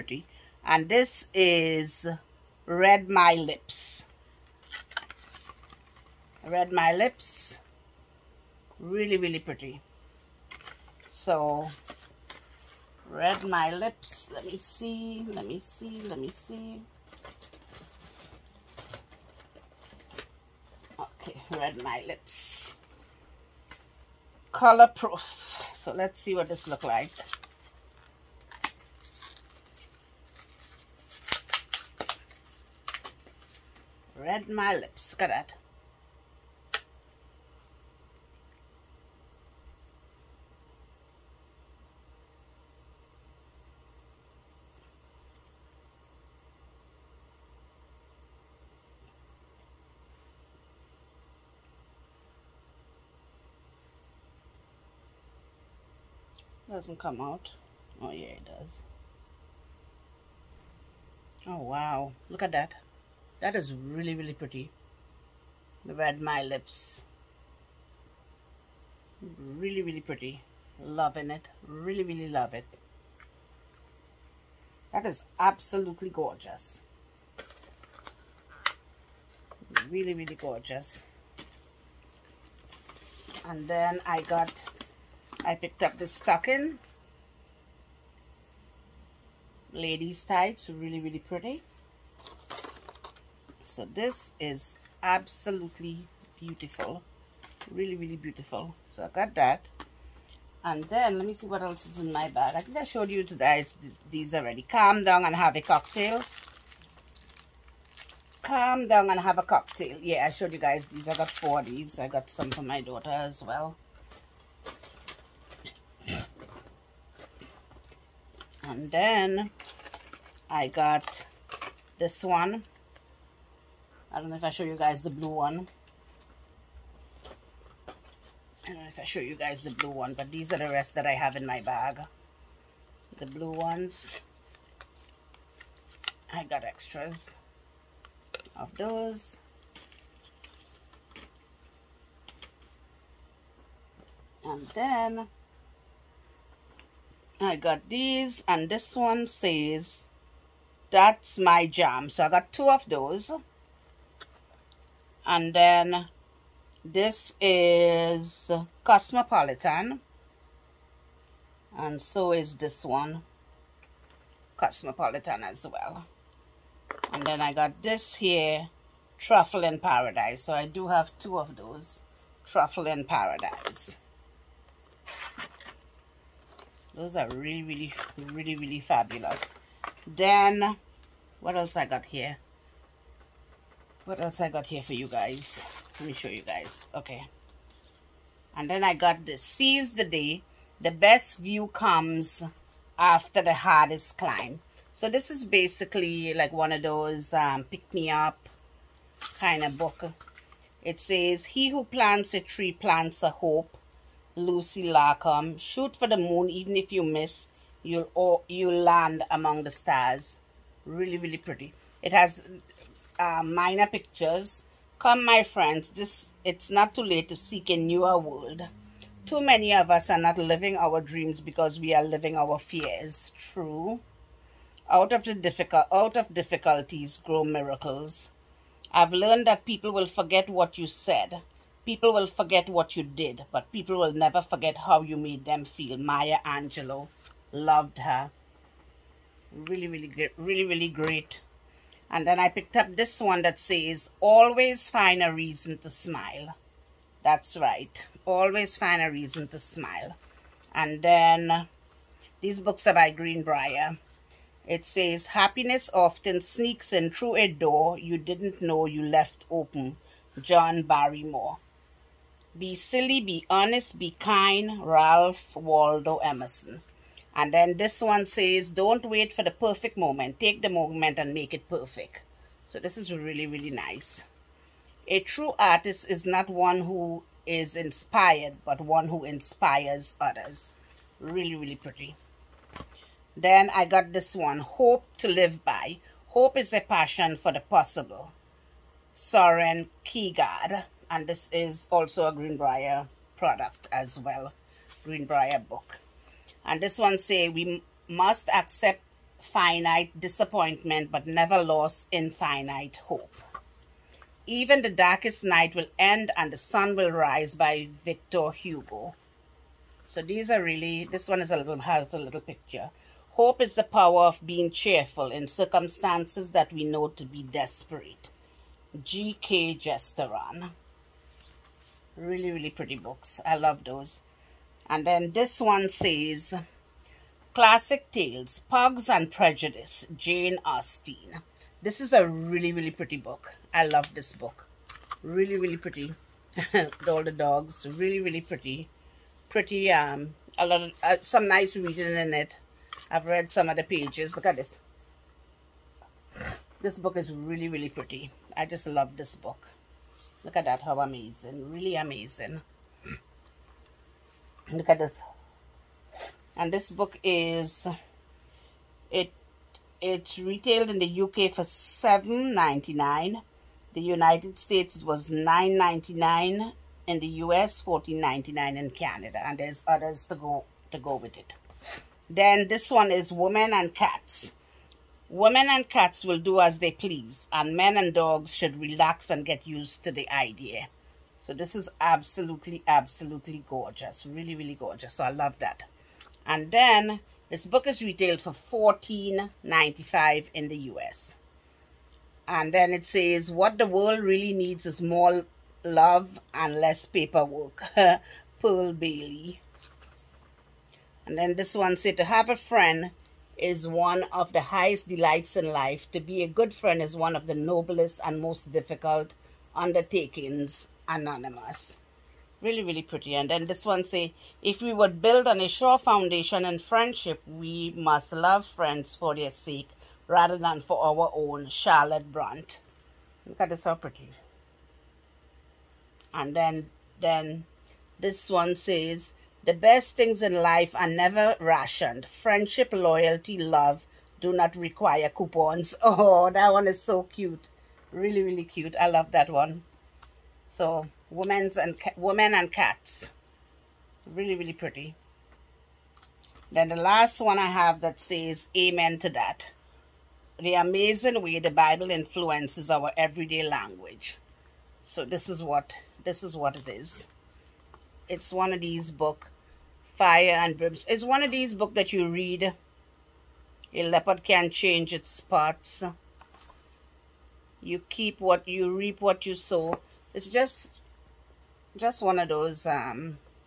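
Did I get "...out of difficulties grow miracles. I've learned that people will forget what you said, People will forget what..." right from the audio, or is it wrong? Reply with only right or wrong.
right.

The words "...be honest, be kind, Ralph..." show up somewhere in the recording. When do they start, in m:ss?
4:23.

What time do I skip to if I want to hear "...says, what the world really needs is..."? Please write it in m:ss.
6:33.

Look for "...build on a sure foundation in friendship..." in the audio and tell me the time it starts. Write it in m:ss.
6:55.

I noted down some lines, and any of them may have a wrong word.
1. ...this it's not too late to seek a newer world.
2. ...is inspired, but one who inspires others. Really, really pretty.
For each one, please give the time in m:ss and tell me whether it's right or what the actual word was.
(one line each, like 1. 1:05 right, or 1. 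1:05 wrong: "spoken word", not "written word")
1. 3:35 right
2. 4:37 right.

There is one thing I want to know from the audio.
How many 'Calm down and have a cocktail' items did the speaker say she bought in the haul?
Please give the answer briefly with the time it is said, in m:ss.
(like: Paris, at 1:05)
4, at 1:51.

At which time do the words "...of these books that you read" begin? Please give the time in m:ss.
7:41.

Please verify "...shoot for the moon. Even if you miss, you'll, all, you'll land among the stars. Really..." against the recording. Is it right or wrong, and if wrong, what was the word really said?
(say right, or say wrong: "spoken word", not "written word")
right.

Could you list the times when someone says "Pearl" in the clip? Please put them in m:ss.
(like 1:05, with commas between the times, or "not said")
6:38.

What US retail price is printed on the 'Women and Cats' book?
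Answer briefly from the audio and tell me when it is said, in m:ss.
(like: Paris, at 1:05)
$14.95, at 6:28.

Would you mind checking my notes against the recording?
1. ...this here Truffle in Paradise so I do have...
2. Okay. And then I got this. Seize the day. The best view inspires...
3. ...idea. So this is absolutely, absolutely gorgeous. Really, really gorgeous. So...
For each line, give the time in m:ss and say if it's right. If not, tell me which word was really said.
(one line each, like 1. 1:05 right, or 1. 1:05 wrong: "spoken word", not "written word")
1. 2:47 right
2. 3:06 wrong: "comes", not "inspires"
3. 6:20 right.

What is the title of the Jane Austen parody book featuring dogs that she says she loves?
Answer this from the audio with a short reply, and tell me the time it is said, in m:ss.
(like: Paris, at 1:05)
Pugs and Prejudice, at 5:28.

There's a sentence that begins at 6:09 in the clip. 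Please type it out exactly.
And there's others to go to go with it.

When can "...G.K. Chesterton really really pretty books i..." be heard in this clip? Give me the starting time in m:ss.
5:19.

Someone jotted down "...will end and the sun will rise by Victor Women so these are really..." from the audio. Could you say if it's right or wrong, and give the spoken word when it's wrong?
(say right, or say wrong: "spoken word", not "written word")
wrong: "Hugo", not "Women".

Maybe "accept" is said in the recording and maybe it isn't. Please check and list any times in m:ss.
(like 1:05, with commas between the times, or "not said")
4:58.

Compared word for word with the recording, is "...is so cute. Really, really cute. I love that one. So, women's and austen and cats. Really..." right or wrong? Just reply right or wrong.
wrong.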